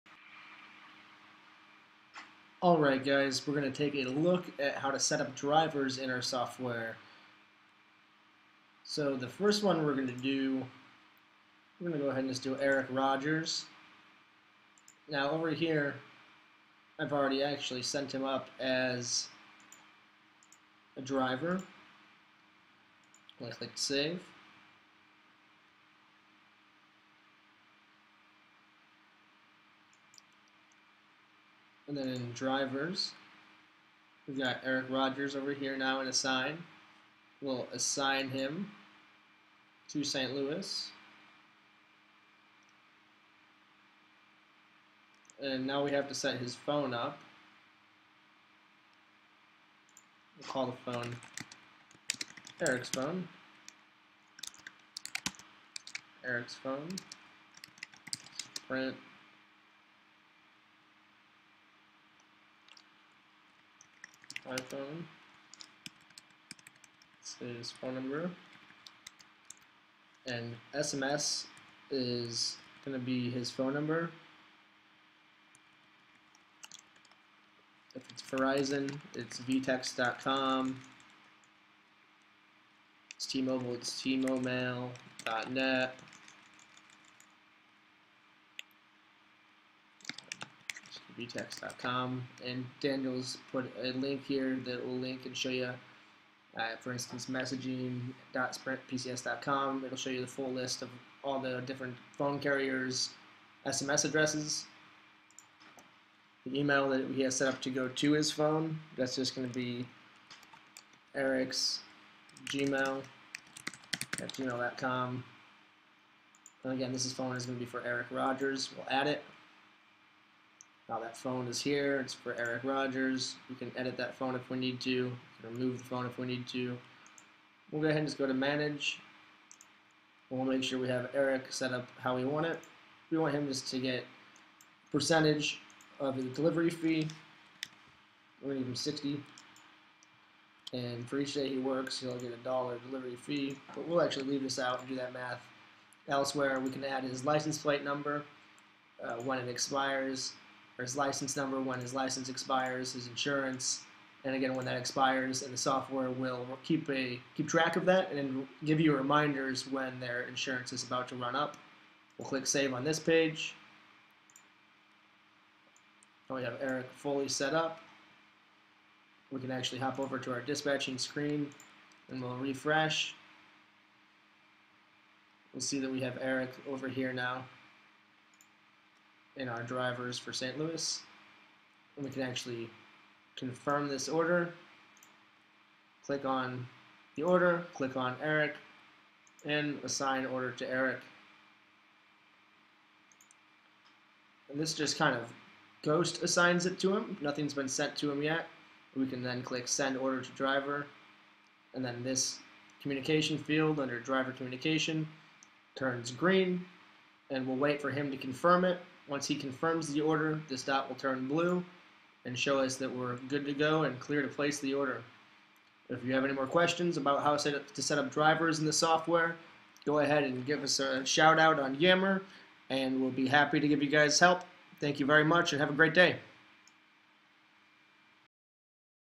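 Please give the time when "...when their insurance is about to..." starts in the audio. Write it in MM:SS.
02:39.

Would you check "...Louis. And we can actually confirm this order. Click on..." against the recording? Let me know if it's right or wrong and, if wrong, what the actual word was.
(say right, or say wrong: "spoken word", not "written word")
right.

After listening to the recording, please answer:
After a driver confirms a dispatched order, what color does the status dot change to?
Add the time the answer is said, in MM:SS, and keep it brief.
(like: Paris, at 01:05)
Blue, at 03:31.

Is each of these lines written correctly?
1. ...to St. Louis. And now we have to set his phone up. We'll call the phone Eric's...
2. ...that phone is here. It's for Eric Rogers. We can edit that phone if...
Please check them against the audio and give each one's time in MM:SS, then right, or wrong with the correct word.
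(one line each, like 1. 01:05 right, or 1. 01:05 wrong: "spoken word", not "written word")
1. 00:39 right
2. 02:00 right.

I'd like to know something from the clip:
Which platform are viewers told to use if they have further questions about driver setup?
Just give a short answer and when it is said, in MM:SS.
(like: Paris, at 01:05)
Yammer, at 03:41.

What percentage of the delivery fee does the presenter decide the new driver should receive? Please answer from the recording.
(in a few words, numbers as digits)
60.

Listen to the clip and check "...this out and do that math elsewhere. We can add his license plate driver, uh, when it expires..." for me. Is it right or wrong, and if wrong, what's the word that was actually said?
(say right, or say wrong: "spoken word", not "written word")
wrong: "number", not "driver".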